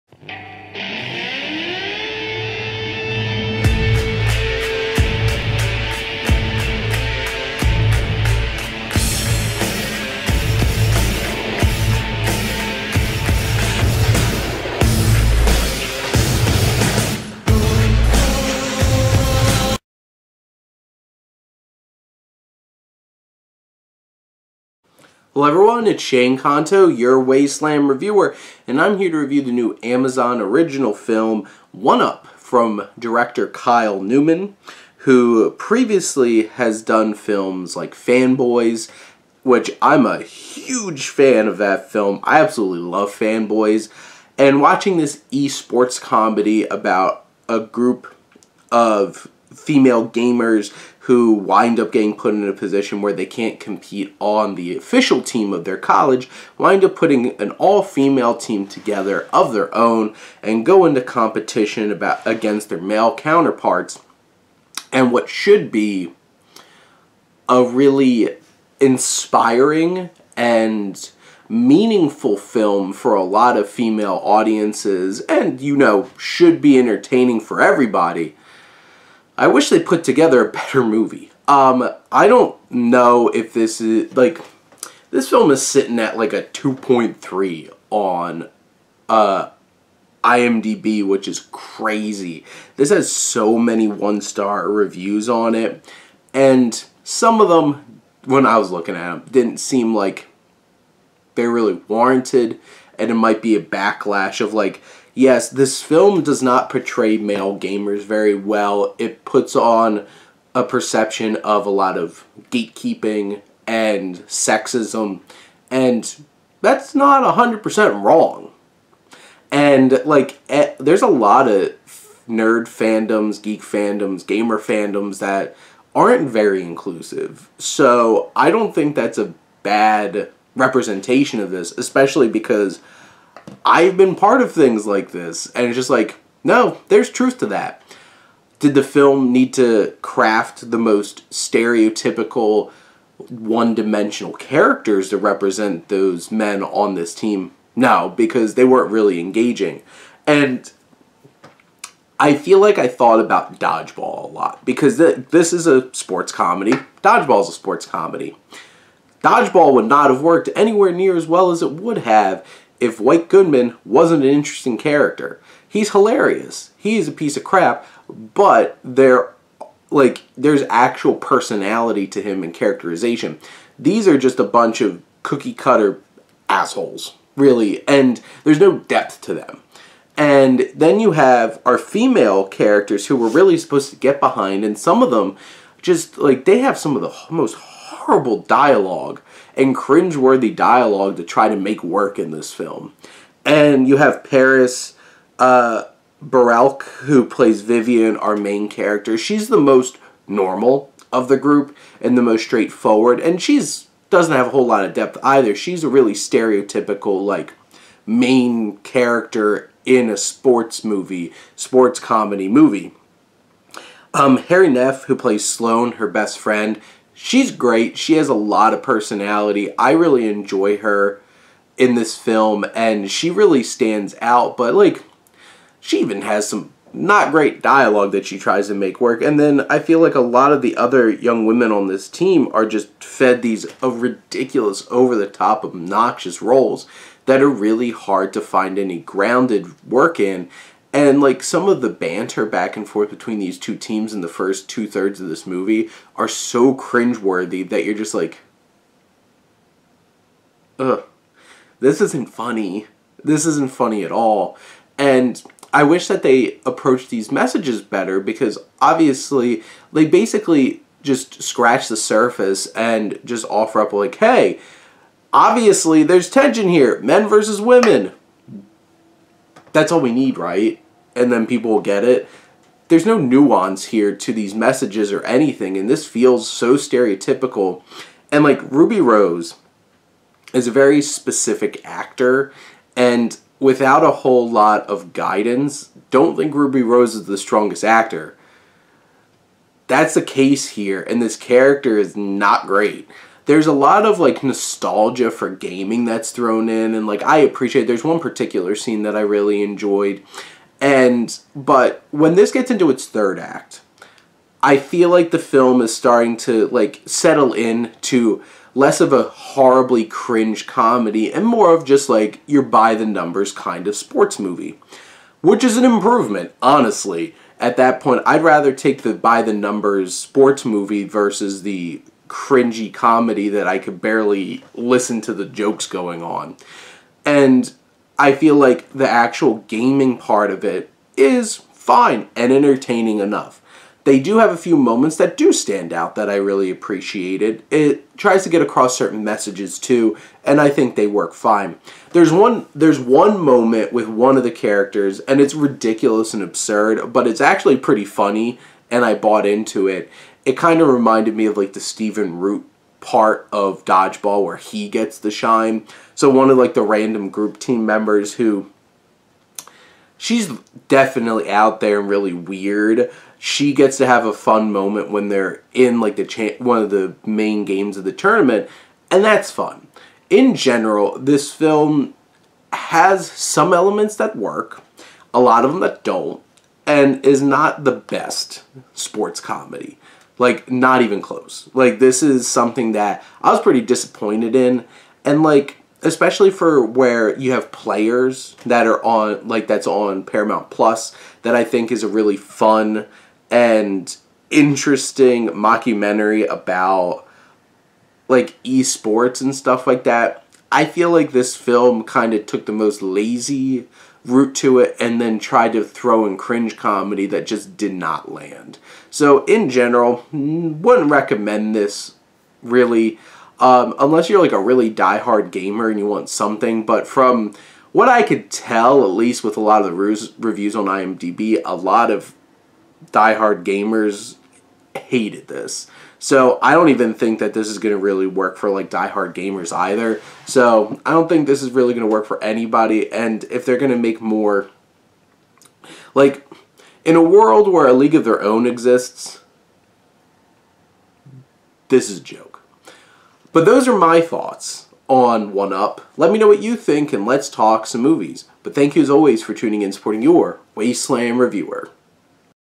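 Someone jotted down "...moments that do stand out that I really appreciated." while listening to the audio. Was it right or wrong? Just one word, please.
right.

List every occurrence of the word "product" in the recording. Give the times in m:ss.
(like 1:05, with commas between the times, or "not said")
not said.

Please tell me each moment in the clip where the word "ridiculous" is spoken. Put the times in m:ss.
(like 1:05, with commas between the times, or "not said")
3:53, 5:45.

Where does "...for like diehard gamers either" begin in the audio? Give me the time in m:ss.
7:08.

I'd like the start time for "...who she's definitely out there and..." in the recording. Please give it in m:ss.
5:58.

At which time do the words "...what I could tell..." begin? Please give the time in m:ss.
6:57.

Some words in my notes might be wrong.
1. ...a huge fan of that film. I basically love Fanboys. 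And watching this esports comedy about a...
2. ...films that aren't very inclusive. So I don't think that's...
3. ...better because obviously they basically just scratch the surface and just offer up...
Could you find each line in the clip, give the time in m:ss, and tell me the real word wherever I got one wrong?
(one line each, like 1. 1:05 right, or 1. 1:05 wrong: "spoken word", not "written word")
1. 0:40 wrong: "absolutely", not "basically"
2. 2:04 wrong: "fandoms", not "films"
3. 4:17 right.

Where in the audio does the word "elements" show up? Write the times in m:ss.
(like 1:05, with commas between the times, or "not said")
6:13.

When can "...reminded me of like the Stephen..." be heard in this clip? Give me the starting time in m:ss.
5:50.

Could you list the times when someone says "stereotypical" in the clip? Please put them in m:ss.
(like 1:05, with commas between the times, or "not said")
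2:21, 3:26, 4:36.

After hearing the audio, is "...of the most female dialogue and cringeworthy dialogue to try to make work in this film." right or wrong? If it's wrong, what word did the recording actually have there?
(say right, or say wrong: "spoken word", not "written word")
wrong: "horrible", not "female".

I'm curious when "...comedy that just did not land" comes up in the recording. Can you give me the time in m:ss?
6:46.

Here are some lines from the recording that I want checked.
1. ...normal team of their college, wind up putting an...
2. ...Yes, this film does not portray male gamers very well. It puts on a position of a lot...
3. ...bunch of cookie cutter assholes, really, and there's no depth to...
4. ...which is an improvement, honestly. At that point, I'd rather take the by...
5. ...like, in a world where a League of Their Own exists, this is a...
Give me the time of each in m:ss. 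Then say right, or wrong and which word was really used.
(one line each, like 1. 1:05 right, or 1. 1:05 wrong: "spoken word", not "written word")
1. 0:54 wrong: "official", not "normal"
2. 1:45 wrong: "perception", not "position"
3. 2:54 right
4. 5:15 right
5. 7:16 right.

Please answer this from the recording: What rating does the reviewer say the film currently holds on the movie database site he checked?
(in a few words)
2.3.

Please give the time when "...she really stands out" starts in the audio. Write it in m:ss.
3:43.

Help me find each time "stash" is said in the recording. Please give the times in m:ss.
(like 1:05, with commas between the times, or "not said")
not said.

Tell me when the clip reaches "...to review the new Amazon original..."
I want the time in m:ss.
0:29.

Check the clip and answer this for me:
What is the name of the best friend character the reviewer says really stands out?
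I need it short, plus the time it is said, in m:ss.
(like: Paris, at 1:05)
Sloane, at 3:35.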